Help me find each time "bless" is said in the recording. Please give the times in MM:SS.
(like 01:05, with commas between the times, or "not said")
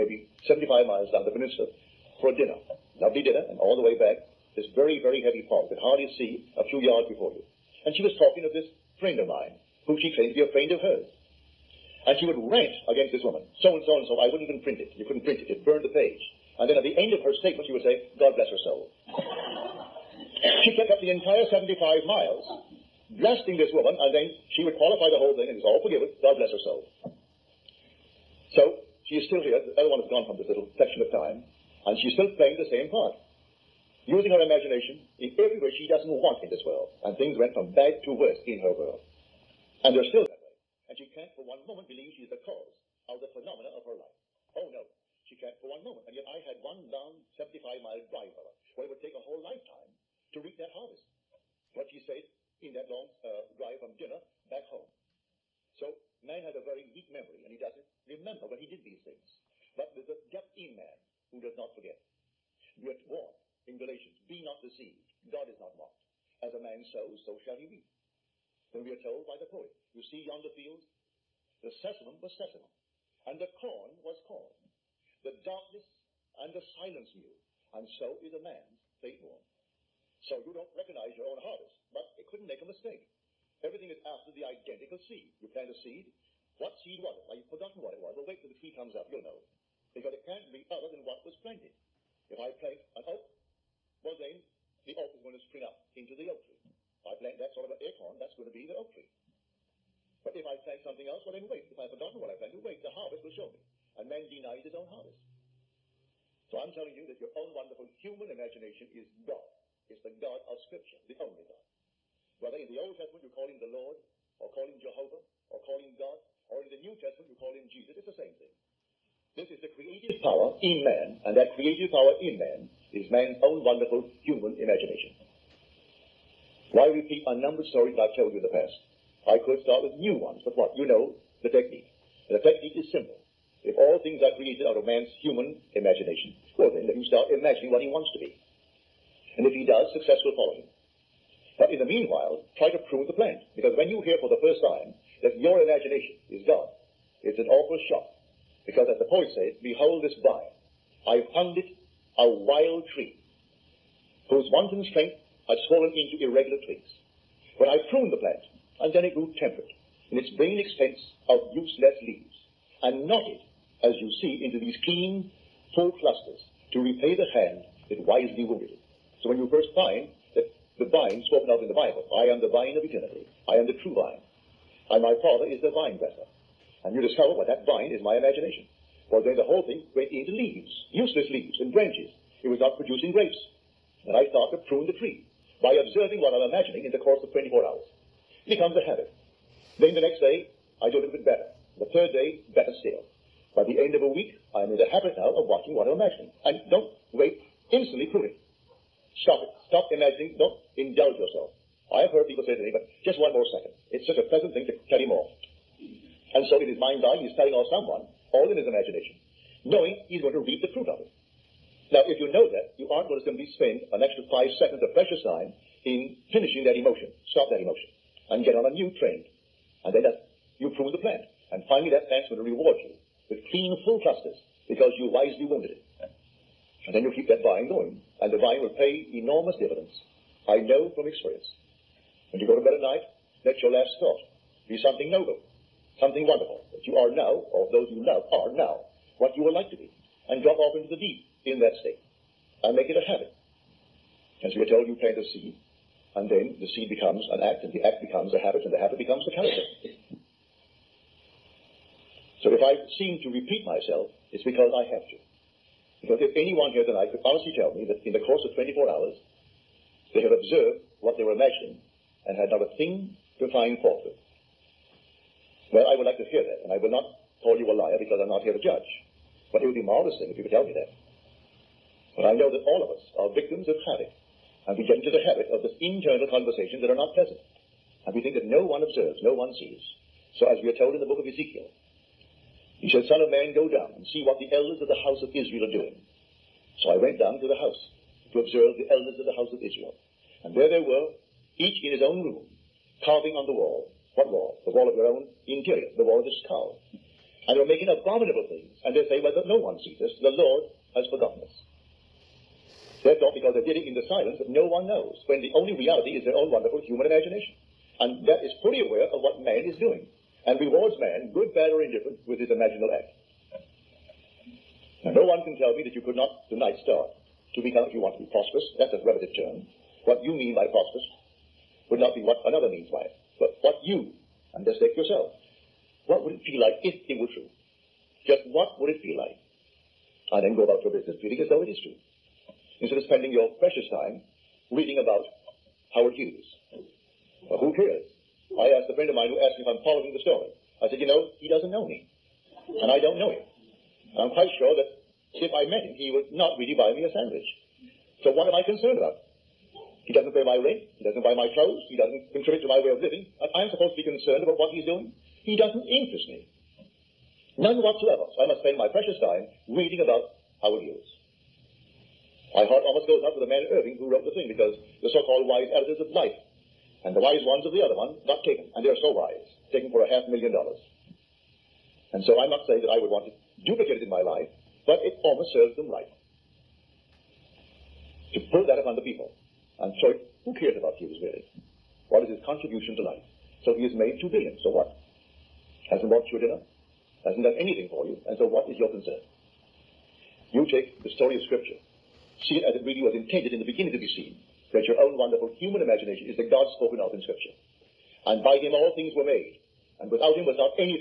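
00:18, 00:26.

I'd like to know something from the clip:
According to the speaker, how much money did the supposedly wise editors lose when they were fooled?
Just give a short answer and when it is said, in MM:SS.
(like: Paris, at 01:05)
half million dollars, at 06:10.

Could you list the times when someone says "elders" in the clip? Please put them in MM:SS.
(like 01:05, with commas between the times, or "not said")
04:44, 04:48.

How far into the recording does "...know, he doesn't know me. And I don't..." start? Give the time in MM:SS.
05:41.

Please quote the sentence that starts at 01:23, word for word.
Everything is after the identical seed.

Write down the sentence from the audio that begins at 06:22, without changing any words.
What is his contribution to life?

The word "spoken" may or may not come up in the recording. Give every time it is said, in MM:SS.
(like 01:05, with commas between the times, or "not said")
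02:51, 06:36.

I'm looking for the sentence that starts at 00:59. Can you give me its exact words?
But there's a depth in man who does not forget.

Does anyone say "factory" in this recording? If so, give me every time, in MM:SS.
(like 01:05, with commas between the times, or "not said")
not said.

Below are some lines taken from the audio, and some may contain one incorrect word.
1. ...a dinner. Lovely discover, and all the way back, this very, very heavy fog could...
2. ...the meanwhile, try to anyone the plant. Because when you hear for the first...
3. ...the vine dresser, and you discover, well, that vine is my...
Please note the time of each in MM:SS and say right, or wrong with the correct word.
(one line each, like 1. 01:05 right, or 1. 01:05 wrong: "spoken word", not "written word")
1. 00:02 wrong: "dinner", not "discover"
2. 02:21 wrong: "prune", not "anyone"
3. 02:55 right.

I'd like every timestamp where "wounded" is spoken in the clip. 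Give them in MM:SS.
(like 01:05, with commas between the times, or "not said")
02:48, 03:45.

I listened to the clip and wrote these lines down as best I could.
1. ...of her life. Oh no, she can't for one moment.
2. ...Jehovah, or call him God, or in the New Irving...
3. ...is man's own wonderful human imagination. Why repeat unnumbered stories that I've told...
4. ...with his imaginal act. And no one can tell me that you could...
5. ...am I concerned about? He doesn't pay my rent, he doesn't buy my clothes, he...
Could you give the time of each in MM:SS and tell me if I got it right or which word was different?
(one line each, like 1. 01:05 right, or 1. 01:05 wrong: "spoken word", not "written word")
1. 00:43 right
2. 01:54 wrong: "Testament", not "Irving"
3. 02:02 right
4. 05:12 right
5. 05:48 right.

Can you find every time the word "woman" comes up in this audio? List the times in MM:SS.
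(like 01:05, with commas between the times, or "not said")
00:13, 00:23.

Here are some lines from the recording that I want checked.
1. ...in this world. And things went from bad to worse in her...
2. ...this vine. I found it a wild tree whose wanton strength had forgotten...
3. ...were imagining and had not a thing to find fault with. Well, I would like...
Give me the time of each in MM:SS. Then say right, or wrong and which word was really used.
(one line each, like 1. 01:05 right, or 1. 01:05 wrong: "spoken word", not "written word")
1. 00:36 right
2. 02:30 wrong: "swollen", not "forgotten"
3. 04:21 right.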